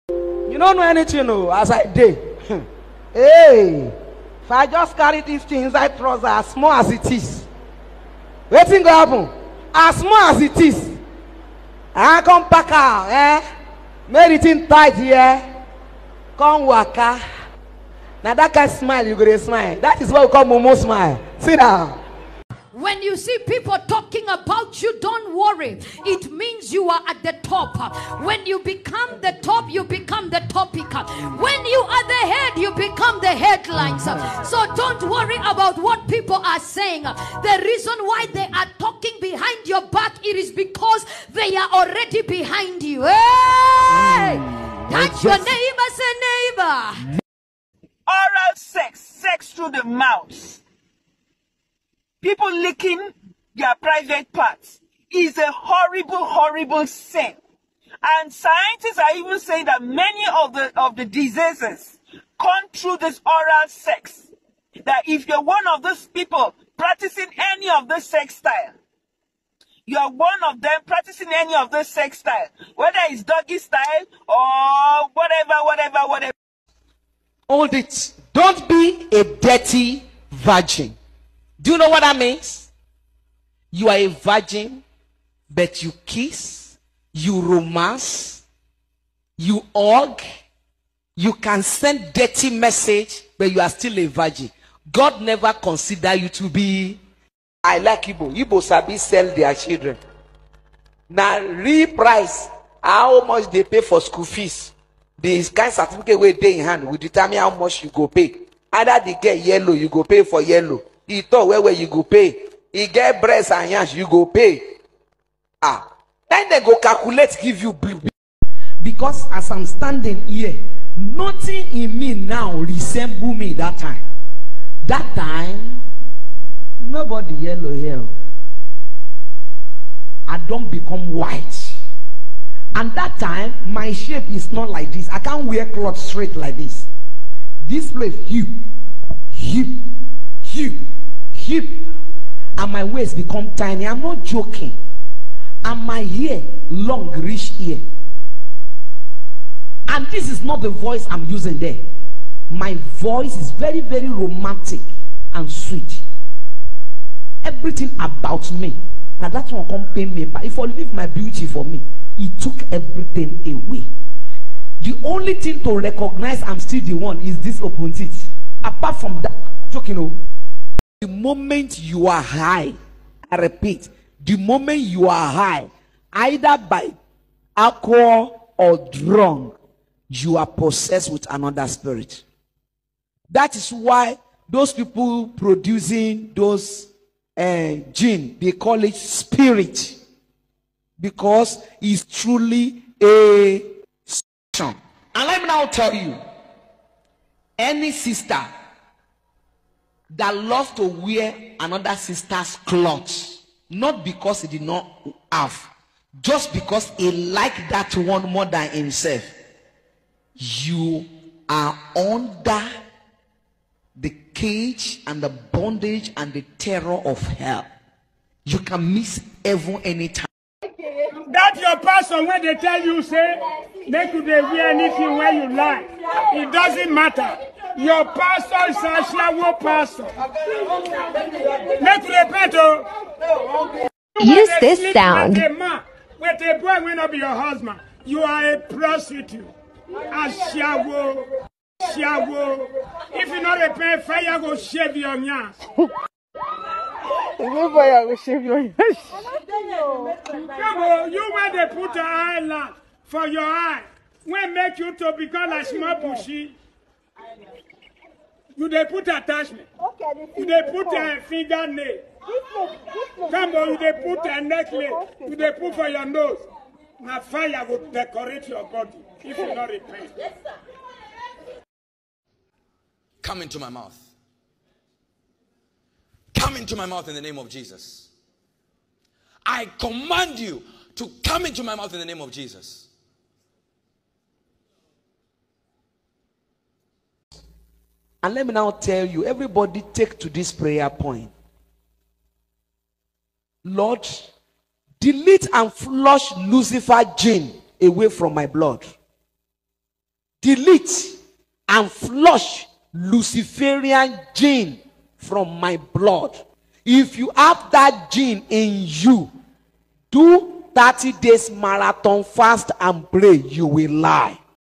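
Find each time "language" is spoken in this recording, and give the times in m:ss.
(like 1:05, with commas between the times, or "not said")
not said.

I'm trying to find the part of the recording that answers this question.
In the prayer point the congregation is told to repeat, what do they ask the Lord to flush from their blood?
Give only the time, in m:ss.
5:02.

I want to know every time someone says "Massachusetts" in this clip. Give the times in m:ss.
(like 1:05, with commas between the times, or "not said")
not said.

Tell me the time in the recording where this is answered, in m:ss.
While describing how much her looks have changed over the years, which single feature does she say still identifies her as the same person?
2:47.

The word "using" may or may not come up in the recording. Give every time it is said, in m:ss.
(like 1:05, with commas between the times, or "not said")
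2:31.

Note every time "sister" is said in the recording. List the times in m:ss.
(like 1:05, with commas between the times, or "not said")
3:17, 3:21.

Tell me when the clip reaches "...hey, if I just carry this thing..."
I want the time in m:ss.
0:03.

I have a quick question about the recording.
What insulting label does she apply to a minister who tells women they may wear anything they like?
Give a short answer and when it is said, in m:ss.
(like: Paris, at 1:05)
shawo pastor, at 3:49.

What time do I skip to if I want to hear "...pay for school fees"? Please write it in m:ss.
1:43.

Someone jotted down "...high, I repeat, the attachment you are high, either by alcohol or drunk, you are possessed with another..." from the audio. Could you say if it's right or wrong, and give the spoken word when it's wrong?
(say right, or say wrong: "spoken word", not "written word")
wrong: "moment", not "attachment".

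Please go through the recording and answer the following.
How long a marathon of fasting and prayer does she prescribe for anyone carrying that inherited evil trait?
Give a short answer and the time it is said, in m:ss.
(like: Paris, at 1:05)
30 days, at 5:10.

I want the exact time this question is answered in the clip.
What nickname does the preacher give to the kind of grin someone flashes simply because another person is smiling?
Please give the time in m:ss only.
0:20.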